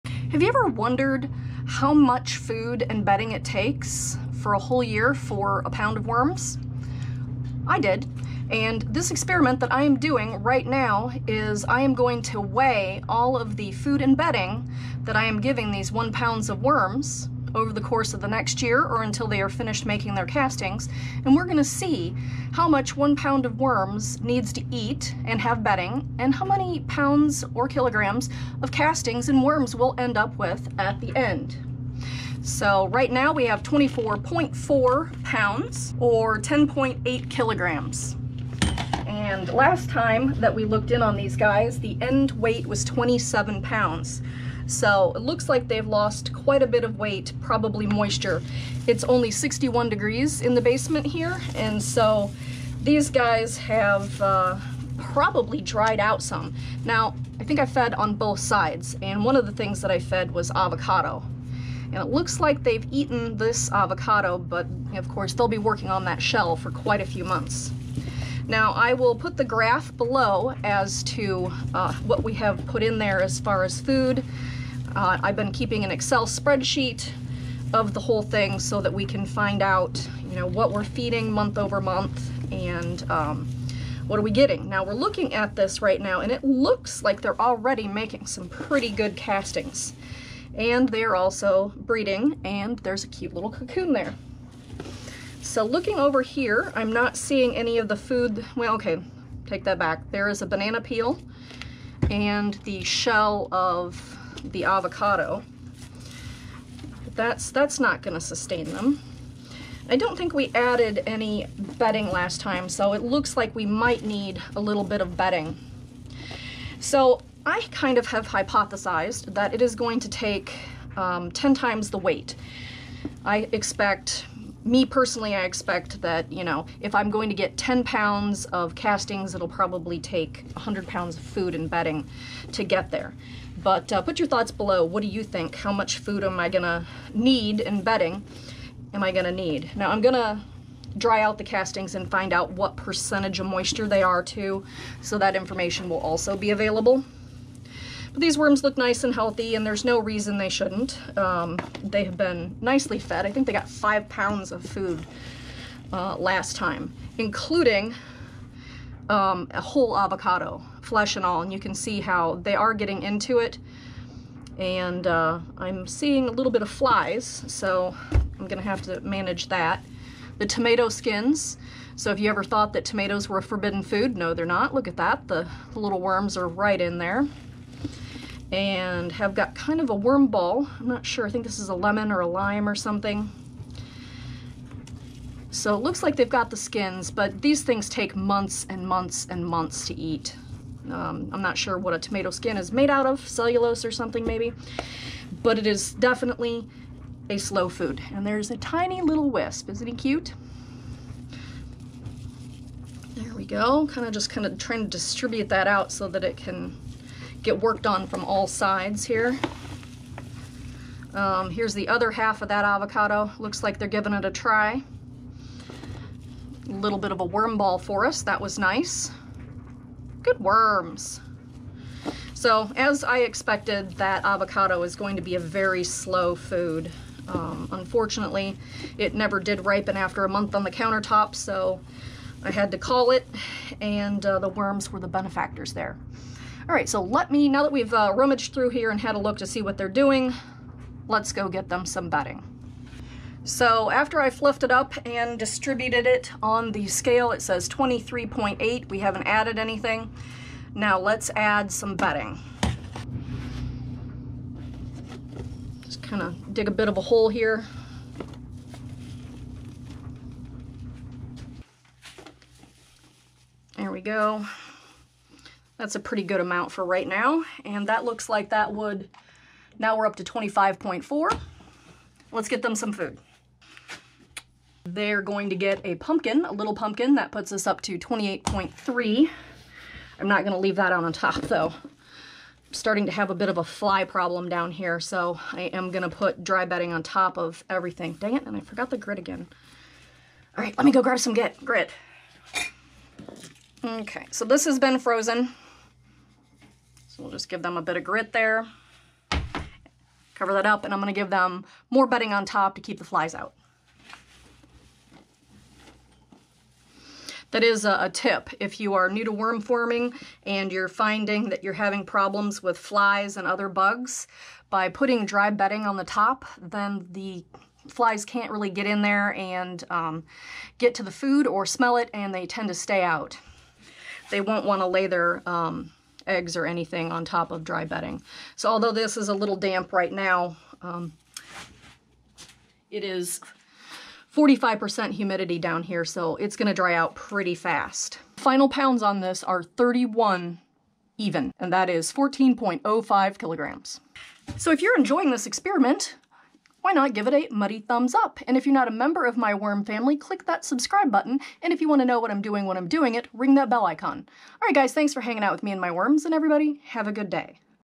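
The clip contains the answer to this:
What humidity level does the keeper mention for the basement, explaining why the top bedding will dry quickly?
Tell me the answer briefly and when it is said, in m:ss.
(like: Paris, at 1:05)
45%, at 5:34.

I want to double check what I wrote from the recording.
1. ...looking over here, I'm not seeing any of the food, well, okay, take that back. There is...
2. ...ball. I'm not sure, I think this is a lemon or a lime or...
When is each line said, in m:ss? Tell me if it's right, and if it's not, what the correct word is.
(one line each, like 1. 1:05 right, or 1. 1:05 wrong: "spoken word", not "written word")
1. 1:35 right
2. 3:00 right.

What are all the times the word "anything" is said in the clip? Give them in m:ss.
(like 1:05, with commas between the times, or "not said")
4:09, 5:26.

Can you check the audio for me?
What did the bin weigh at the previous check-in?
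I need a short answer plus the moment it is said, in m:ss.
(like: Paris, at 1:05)
27 pounds, at 0:42.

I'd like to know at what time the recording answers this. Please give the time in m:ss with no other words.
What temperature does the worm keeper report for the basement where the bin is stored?
0:49.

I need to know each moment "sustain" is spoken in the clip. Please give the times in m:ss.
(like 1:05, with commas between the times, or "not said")
1:48.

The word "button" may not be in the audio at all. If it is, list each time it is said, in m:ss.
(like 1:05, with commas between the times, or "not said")
5:51.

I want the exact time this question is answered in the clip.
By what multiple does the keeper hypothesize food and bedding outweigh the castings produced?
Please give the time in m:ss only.
2:01.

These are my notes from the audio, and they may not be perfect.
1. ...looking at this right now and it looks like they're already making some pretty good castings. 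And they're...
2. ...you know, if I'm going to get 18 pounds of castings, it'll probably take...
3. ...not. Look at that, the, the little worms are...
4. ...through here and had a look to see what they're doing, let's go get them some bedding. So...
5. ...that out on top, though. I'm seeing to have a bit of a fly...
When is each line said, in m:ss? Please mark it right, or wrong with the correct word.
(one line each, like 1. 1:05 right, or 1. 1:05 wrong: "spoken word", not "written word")
1. 1:24 right
2. 2:06 wrong: "10", not "18"
3. 2:54 right
4. 3:58 right
5. 4:40 wrong: "starting", not "seeing".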